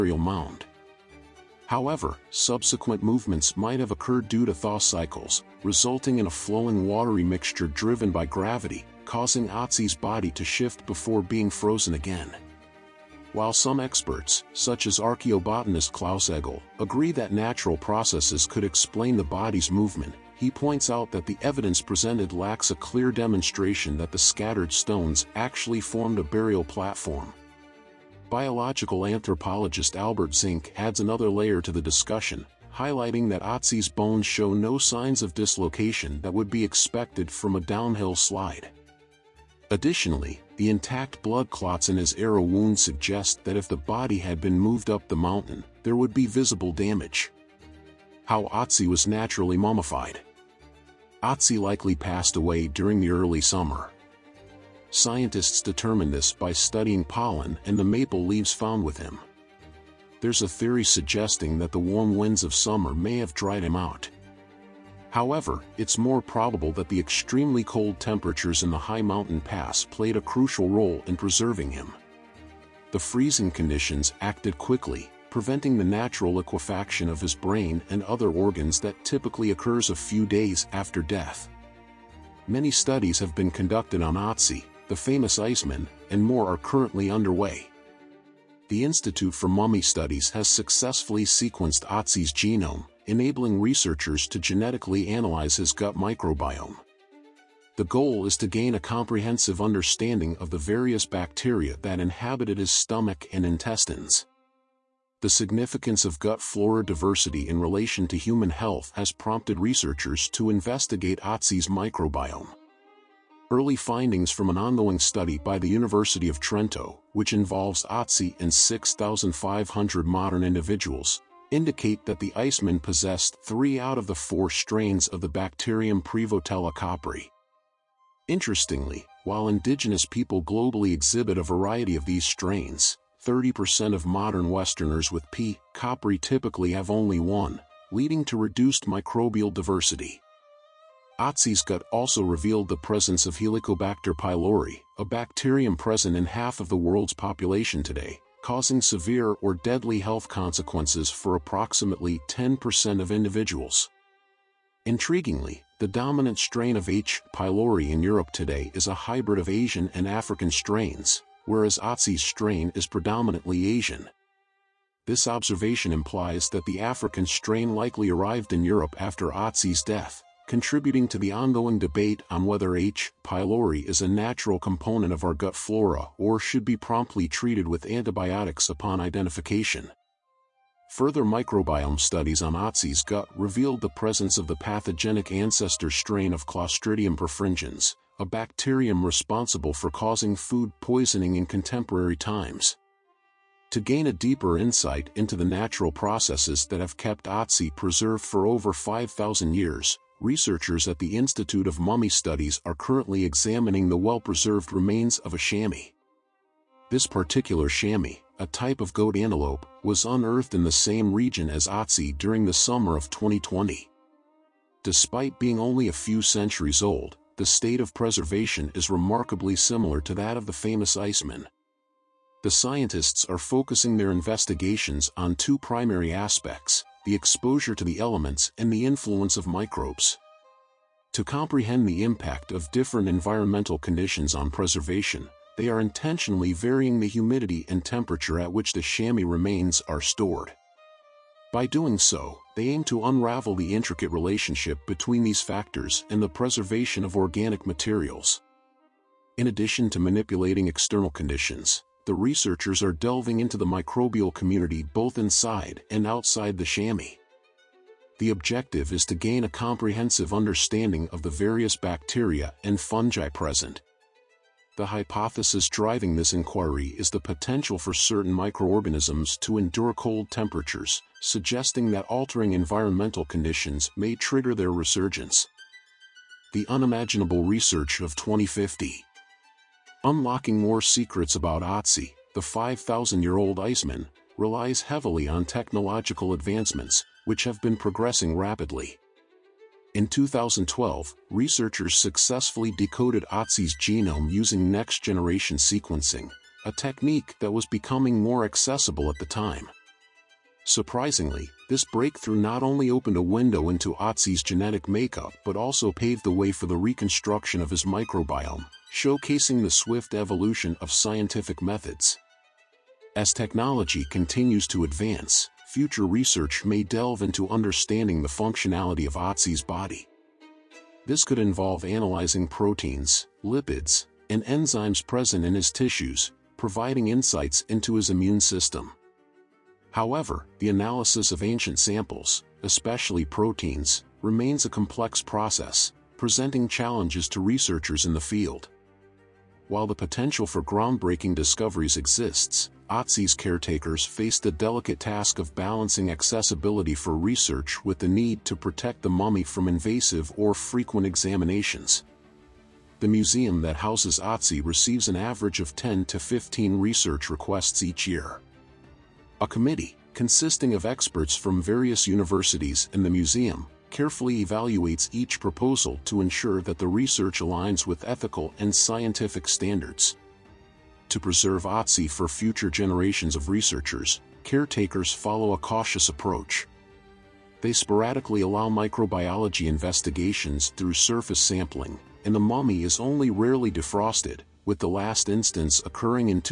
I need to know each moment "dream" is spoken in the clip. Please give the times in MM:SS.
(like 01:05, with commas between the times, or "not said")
not said.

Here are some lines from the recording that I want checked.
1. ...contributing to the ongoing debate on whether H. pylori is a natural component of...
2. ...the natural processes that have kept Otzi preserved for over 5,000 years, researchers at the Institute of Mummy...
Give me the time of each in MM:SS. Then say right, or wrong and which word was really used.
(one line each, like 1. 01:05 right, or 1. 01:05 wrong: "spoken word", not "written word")
1. 02:50 right
2. 03:15 right.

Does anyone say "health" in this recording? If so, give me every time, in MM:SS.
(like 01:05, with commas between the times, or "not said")
01:48, 02:29.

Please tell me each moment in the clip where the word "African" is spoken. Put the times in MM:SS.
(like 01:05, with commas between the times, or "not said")
02:40, 02:46.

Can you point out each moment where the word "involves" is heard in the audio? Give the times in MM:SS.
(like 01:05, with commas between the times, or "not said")
01:57, 05:21.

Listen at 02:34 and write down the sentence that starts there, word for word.
Intriguingly, the dominant strain of H.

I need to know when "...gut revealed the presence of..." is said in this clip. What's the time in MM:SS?
03:03.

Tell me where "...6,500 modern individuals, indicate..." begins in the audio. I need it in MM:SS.
01:58.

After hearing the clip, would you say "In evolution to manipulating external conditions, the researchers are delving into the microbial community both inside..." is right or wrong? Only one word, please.
wrong.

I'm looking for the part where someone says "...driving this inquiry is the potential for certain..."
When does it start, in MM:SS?
04:25.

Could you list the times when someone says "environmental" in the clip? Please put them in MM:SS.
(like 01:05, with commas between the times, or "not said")
03:53, 04:32.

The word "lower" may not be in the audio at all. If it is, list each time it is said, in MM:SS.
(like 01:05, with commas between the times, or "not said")
not said.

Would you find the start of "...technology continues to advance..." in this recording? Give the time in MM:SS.
05:13.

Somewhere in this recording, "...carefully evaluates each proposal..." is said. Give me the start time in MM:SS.
06:03.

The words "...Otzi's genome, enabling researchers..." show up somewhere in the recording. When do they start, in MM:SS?
01:31.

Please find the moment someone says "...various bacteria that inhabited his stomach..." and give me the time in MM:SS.
01:40.